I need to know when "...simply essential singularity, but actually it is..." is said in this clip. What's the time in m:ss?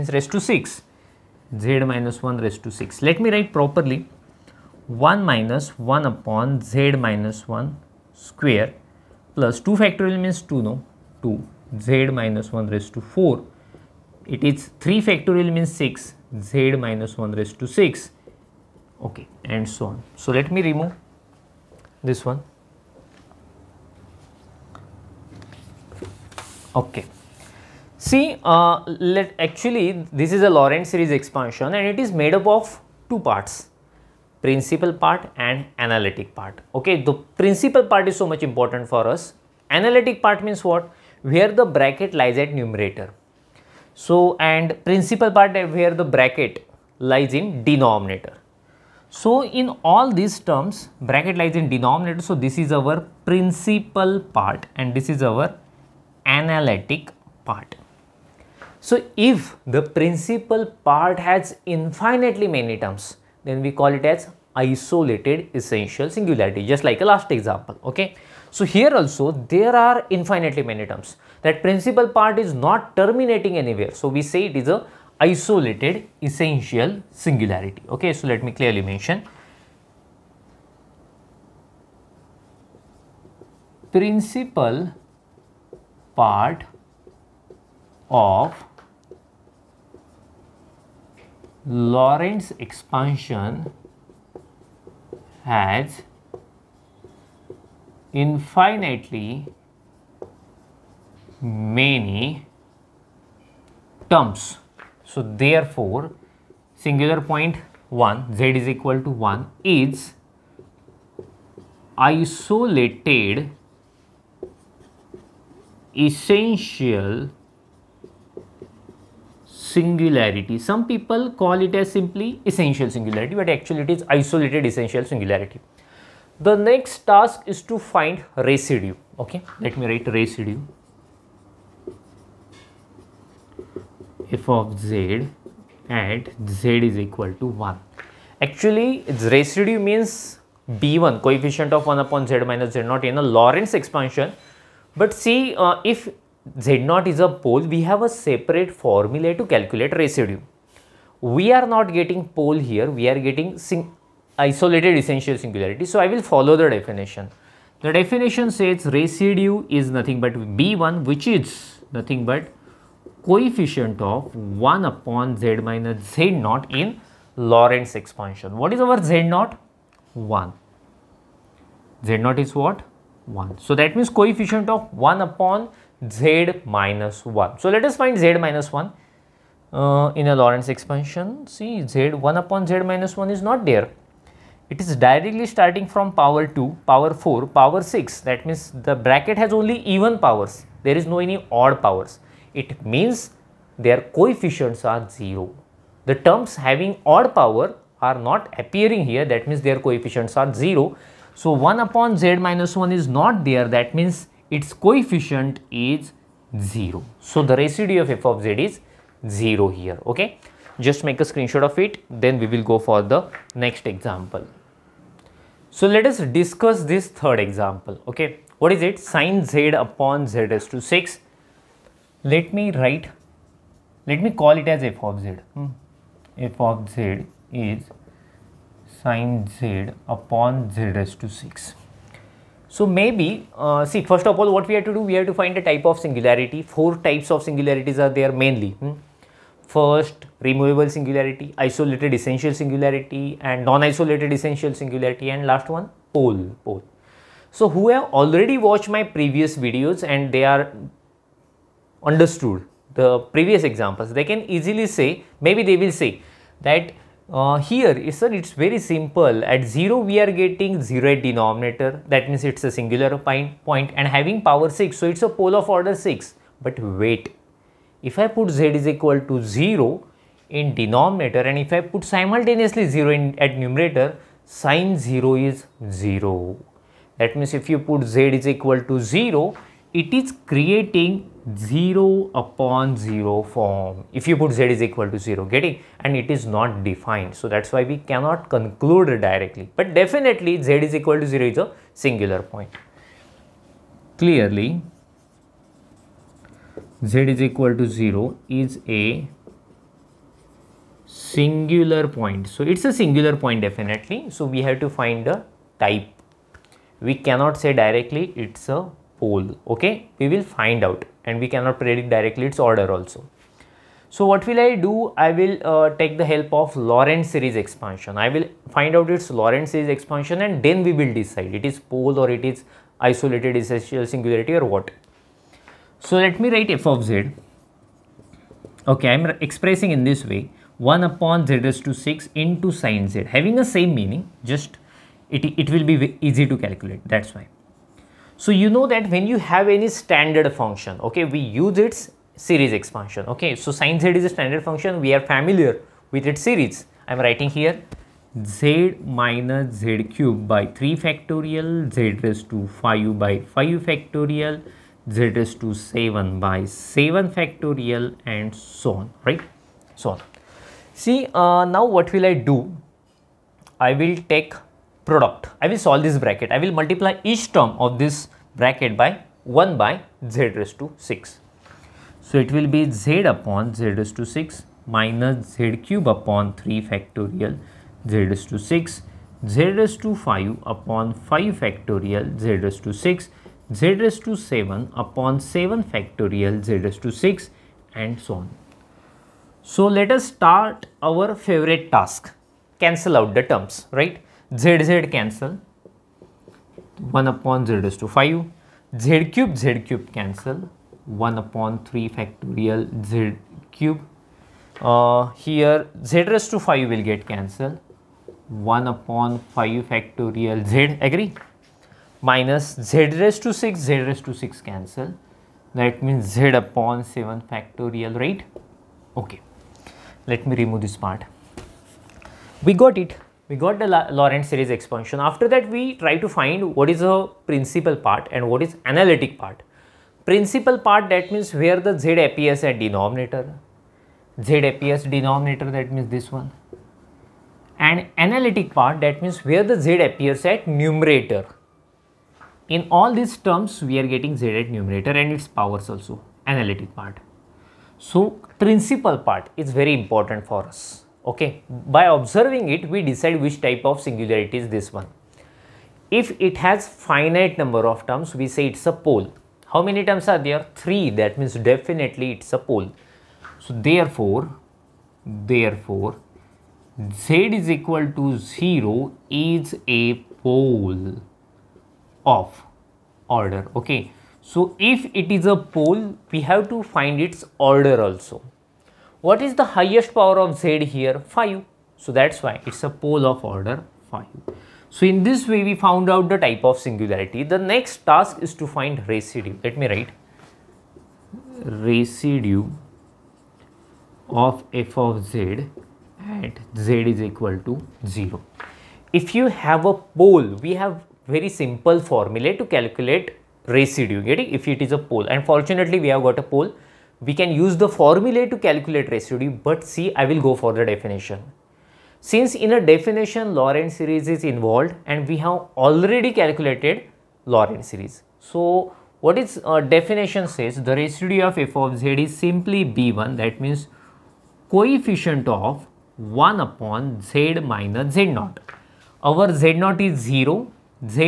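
2:01.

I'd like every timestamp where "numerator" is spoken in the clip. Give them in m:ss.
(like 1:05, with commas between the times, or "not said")
0:42, 4:33, 7:20, 7:24.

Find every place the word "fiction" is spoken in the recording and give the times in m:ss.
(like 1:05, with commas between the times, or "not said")
not said.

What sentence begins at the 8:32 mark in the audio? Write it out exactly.
Since in a definition Laurent series is involved and we have already calculated Laurent series.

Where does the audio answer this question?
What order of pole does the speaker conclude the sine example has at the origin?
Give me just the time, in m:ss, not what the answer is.
8:02.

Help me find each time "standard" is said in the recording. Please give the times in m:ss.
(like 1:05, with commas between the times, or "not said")
5:39, 5:44.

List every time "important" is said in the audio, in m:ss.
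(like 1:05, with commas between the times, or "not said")
0:38, 7:29.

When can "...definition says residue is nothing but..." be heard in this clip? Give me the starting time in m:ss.
2:37.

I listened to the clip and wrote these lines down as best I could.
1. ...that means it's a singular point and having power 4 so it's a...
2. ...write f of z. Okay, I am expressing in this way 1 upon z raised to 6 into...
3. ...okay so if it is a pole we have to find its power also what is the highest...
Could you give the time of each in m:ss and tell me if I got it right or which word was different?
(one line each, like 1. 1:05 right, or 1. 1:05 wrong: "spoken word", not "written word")
1. 4:22 wrong: "6", not "4"
2. 5:26 right
3. 7:53 wrong: "order", not "power".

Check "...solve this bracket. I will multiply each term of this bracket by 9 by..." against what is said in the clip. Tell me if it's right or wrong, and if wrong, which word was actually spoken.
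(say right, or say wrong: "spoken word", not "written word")
wrong: "1", not "9".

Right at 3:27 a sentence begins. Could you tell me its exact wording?
So the residue of f of z is 0 here.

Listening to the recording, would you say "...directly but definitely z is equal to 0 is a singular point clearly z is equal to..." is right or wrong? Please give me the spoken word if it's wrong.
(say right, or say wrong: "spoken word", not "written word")
right.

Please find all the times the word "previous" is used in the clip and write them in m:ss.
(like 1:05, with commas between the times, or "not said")
4:09, 4:13.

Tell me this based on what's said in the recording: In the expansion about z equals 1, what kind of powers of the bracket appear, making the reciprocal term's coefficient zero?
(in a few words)
even powers.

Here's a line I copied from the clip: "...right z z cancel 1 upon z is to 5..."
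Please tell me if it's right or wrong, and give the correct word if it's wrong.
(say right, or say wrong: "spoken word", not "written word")
right.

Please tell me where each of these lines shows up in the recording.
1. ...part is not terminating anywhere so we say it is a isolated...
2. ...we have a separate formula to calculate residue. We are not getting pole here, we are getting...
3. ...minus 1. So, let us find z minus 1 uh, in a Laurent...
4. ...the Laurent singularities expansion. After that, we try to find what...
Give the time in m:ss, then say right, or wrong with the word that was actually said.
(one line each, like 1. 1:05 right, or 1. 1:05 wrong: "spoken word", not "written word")
1. 1:12 right
2. 2:27 right
3. 2:56 right
4. 7:03 wrong: "series", not "singularities".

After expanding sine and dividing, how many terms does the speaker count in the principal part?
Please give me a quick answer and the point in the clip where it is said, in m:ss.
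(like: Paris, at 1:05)
3, at 7:40.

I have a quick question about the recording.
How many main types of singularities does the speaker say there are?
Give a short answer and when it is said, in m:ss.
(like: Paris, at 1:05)
Four, at 3:56.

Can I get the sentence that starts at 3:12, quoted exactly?
It means their coefficients are 0.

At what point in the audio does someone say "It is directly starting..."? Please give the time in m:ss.
3:04.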